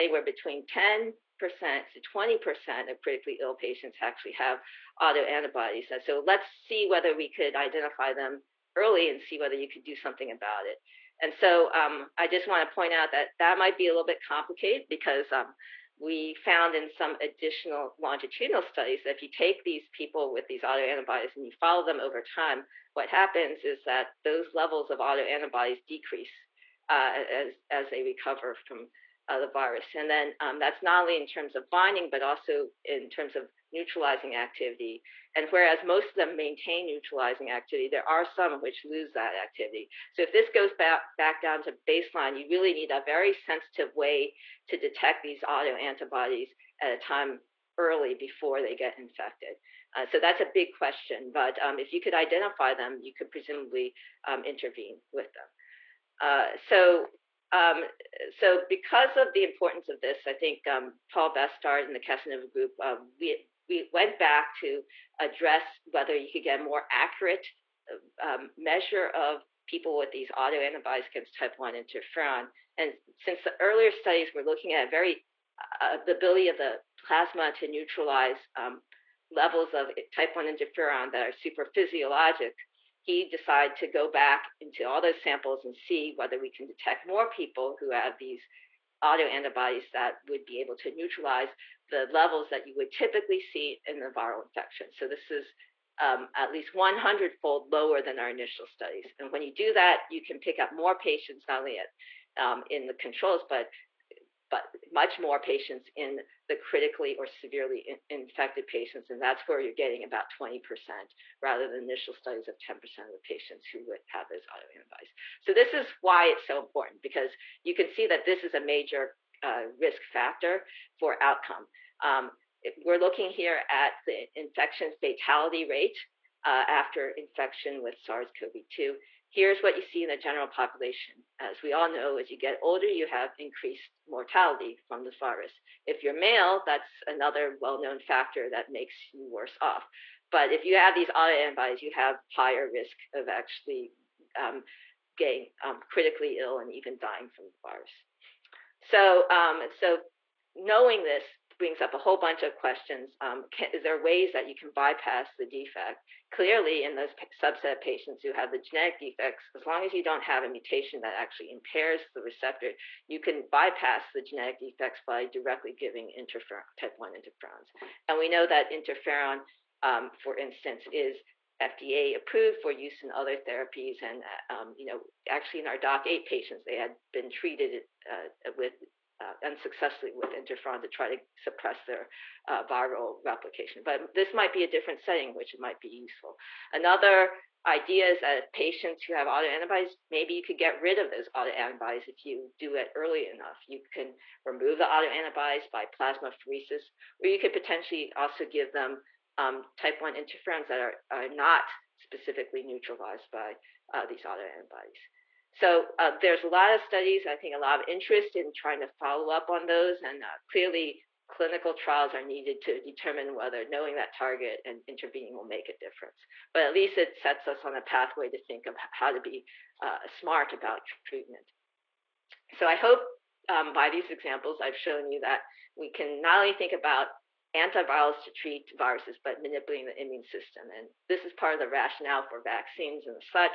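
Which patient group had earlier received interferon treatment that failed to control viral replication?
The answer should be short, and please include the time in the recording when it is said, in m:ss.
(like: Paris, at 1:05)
DOCK8 patients, at 2:55.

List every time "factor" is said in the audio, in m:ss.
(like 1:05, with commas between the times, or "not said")
2:00, 2:17.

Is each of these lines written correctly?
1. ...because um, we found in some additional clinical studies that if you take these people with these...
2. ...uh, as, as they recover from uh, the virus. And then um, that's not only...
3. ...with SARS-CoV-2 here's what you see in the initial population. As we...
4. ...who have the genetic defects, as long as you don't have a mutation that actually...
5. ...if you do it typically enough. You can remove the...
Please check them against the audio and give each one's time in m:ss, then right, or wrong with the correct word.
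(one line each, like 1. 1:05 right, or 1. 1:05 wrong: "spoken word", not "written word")
1. 0:14 wrong: "longitudinal", not "clinical"
2. 0:26 right
3. 2:07 wrong: "general", not "initial"
4. 2:38 right
5. 3:12 wrong: "early", not "typically".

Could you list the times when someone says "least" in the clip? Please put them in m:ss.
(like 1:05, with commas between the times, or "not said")
1:36, 3:36.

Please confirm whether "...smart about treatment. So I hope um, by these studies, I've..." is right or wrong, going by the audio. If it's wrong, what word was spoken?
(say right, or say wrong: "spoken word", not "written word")
wrong: "examples", not "studies".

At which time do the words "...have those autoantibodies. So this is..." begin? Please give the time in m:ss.
1:54.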